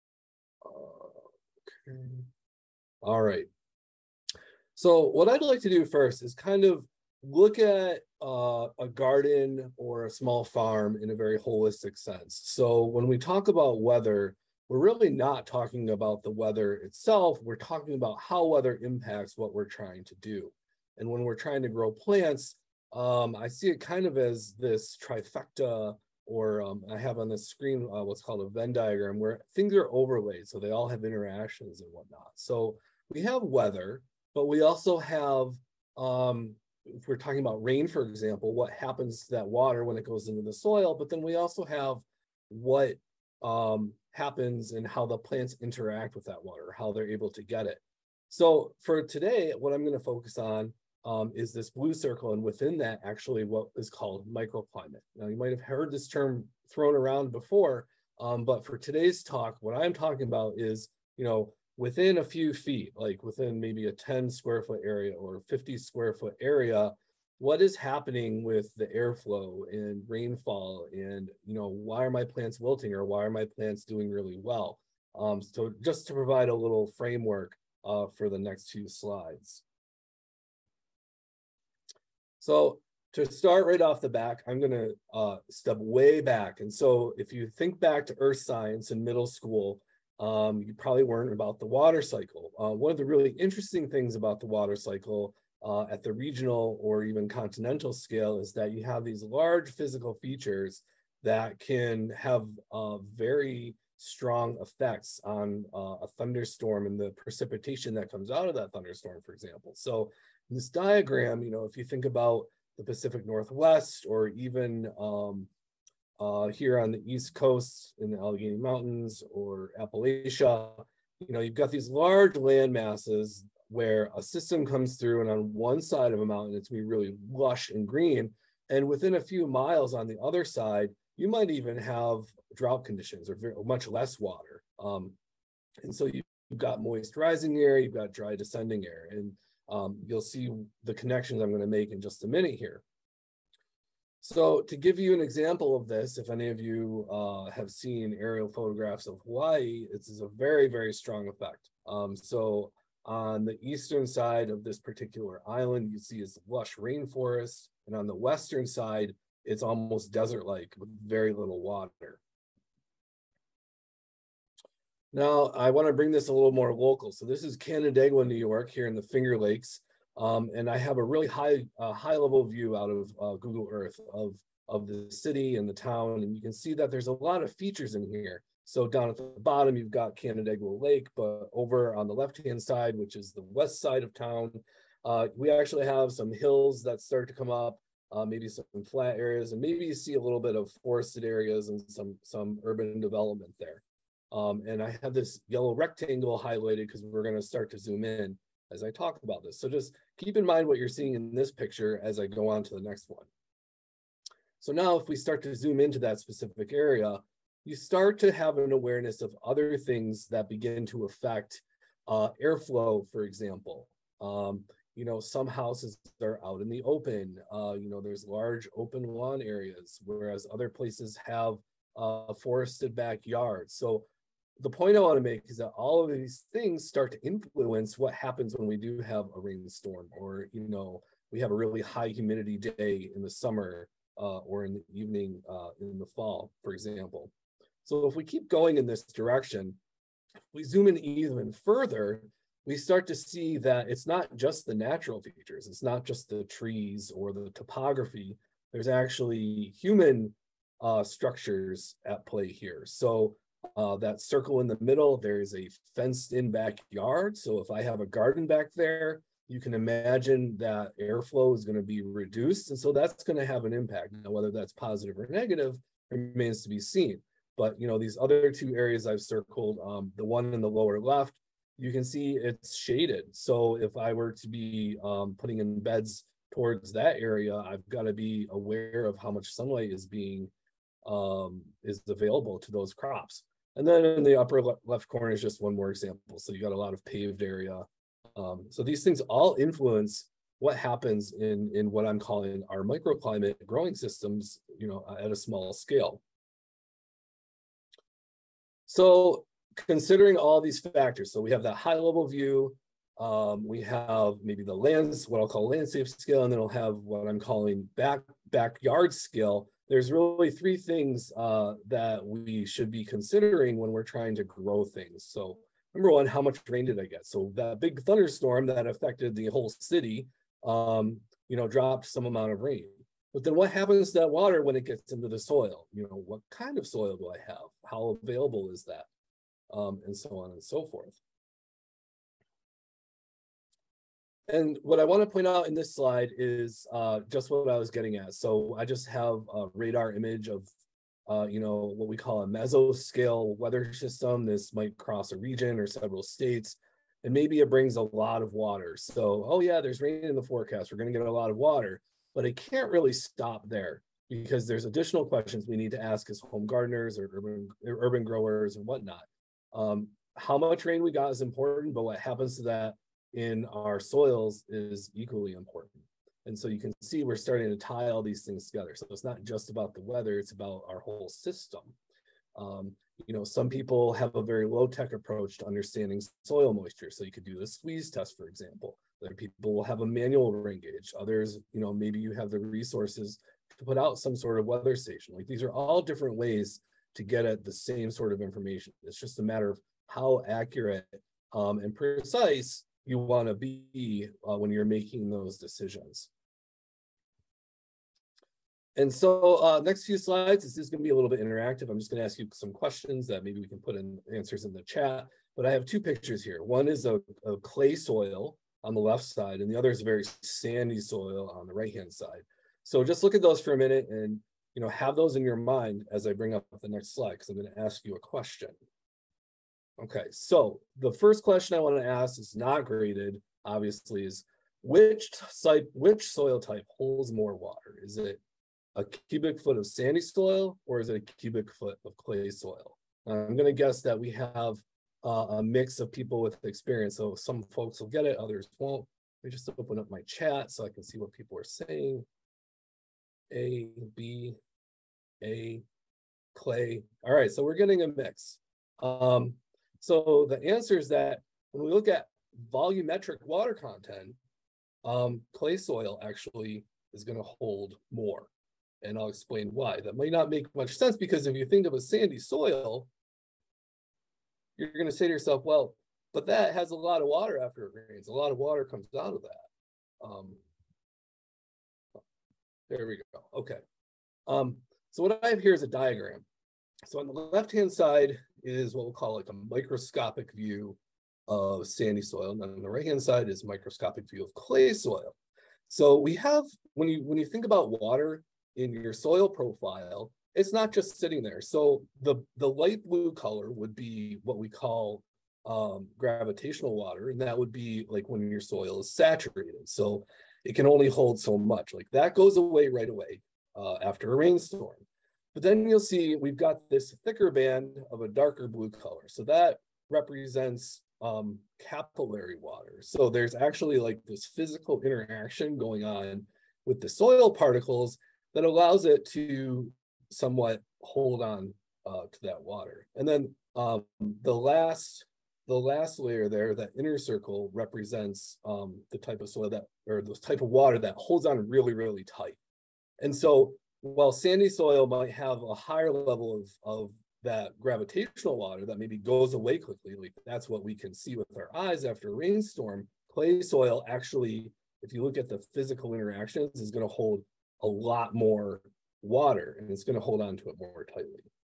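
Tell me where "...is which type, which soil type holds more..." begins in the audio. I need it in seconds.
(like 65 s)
424 s.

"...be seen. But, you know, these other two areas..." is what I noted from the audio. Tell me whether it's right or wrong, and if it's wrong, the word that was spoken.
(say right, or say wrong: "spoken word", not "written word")
right.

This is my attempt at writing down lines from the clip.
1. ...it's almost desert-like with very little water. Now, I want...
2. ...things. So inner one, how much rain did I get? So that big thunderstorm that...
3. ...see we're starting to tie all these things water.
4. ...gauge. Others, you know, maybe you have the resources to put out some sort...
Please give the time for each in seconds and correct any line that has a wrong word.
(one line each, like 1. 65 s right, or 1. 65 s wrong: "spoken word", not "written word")
1. 159 s right
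2. 314 s wrong: "number", not "inner"
3. 367 s wrong: "together", not "water"
4. 380 s right.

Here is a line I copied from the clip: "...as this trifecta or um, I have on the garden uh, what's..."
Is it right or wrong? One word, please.
wrong.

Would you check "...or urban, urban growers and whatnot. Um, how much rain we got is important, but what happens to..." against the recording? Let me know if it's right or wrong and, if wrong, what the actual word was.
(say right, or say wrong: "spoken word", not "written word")
right.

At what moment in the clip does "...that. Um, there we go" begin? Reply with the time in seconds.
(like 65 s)
469 s.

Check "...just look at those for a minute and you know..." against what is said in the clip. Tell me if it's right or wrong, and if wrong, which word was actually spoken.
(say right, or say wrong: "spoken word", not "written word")
right.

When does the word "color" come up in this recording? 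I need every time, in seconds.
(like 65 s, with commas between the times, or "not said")
493 s, 508 s.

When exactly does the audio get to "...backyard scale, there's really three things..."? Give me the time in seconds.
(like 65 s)
308 s.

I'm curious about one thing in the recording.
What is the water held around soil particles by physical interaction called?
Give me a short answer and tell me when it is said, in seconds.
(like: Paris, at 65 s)
capillary water, at 511 s.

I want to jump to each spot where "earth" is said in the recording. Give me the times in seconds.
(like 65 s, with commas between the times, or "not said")
88 s, 173 s.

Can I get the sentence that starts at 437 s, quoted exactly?
So some folks will get it, others won't.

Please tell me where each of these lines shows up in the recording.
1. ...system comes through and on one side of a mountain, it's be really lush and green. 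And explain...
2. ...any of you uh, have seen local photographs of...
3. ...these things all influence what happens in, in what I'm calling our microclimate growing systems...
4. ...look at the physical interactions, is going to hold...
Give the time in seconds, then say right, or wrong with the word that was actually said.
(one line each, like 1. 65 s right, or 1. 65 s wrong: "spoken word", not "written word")
1. 124 s wrong: "within", not "explain"
2. 146 s wrong: "aerial", not "local"
3. 288 s right
4. 545 s right.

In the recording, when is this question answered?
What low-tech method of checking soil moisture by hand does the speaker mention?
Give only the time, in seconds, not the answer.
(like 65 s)
377 s.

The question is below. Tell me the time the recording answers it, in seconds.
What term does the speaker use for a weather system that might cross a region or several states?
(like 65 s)
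342 s.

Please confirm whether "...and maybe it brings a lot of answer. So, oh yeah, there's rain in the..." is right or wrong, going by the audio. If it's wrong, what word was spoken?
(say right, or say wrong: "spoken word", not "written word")
wrong: "water", not "answer".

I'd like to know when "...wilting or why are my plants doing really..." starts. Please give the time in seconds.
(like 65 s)
72 s.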